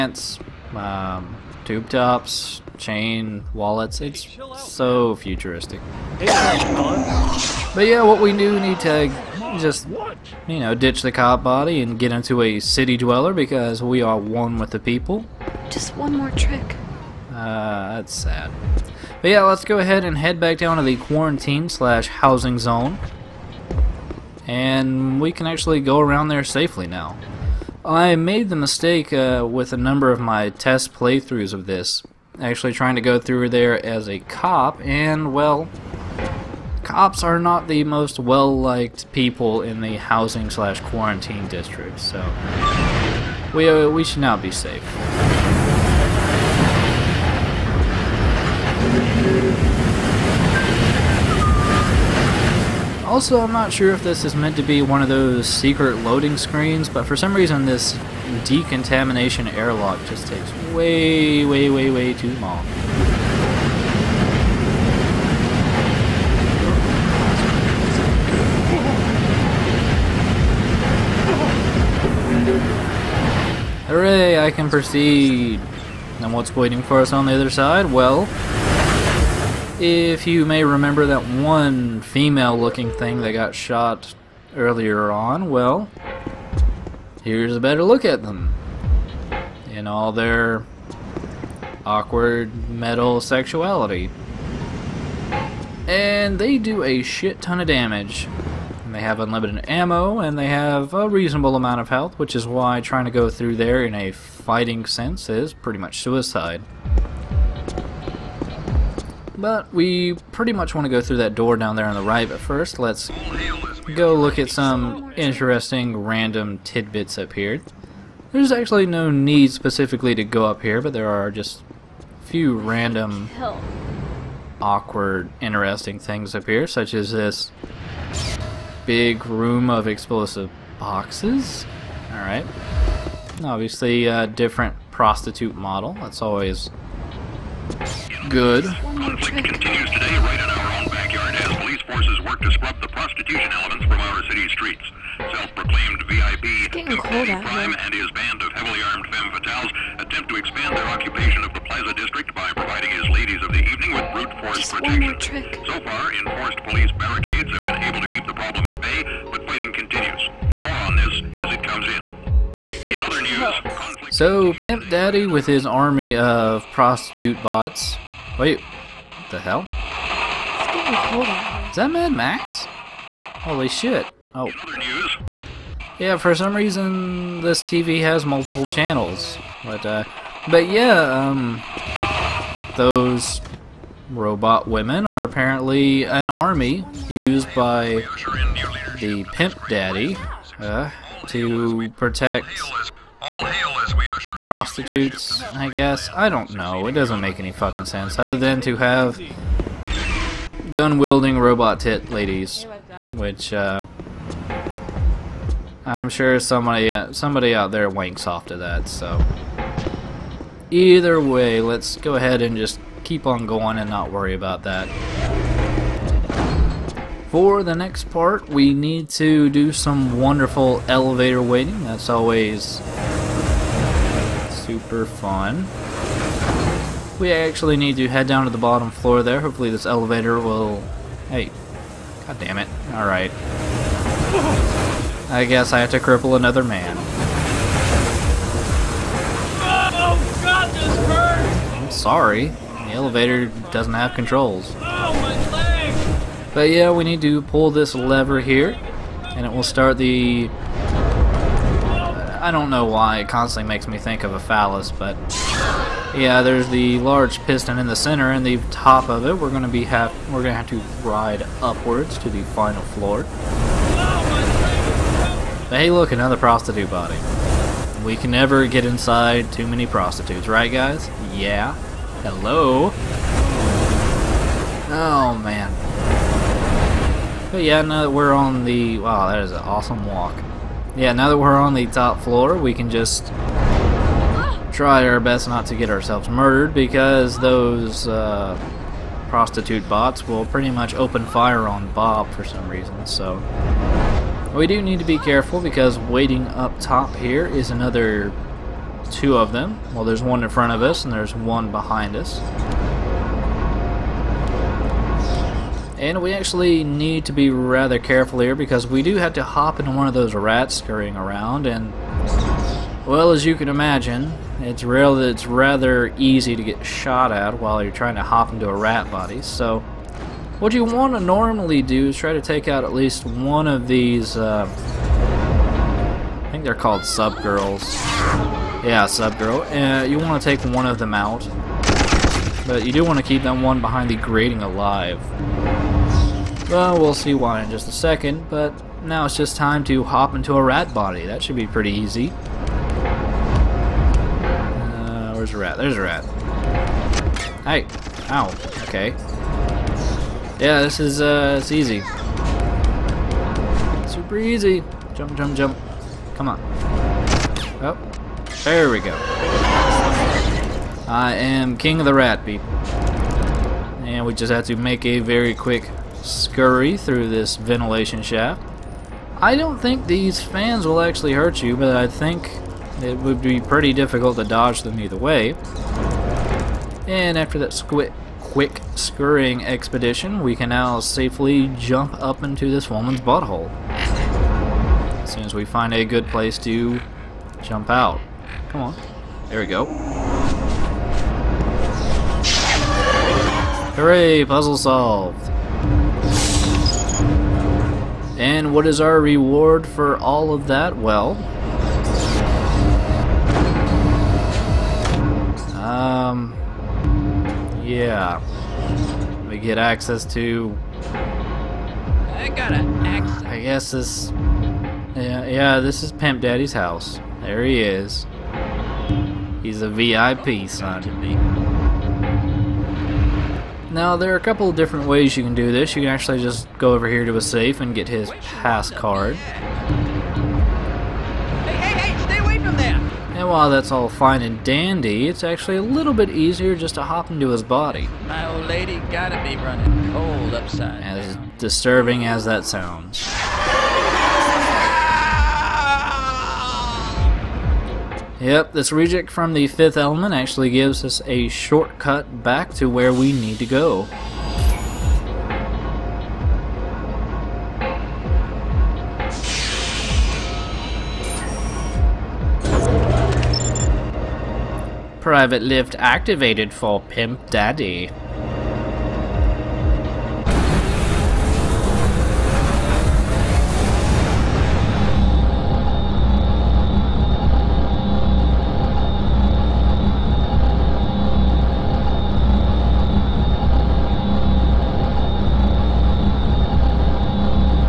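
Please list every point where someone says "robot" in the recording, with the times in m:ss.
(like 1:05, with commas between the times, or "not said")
3:04, 3:21.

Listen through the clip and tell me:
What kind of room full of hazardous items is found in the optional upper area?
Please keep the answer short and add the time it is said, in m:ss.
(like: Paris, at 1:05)
Explosive boxes, at 2:09.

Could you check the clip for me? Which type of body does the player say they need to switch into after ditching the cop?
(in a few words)
City dweller.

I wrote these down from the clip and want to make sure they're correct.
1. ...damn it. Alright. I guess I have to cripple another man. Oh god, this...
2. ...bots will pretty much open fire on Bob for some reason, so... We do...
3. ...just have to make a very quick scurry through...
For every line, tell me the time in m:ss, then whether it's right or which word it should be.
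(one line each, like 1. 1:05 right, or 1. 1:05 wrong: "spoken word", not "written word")
1. 3:52 right
2. 4:49 right
3. 6:04 right.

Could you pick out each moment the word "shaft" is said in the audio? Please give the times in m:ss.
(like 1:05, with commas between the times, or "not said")
6:08.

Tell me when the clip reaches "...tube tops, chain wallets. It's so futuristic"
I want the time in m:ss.
0:01.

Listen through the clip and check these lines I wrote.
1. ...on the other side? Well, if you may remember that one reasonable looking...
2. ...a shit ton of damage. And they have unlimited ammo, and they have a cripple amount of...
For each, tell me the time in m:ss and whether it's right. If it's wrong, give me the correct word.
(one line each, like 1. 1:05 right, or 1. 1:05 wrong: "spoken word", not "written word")
1. 1:17 wrong: "female", not "reasonable"
2. 1:36 wrong: "reasonable", not "cripple".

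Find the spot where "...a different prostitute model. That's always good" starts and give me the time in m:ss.
2:14.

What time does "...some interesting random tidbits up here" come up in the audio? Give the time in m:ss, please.
1:54.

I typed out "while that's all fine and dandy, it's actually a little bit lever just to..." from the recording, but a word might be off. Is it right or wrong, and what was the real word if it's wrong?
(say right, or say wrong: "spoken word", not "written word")
wrong: "easier", not "lever".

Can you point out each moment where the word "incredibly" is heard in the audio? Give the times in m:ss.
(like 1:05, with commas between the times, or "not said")
not said.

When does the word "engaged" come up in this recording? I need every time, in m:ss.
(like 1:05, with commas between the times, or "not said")
not said.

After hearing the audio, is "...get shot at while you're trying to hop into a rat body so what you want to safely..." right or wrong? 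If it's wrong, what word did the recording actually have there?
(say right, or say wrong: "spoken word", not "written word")
wrong: "normally", not "safely".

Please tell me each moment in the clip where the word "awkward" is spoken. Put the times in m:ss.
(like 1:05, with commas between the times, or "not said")
1:31, 2:04.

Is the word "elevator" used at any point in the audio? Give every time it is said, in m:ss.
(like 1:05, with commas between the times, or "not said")
3:40, 3:49, 4:02.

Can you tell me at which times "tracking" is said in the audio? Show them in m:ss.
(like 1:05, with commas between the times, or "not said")
not said.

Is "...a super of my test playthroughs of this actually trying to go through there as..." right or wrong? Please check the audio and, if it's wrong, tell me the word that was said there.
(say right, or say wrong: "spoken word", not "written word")
wrong: "number", not "super".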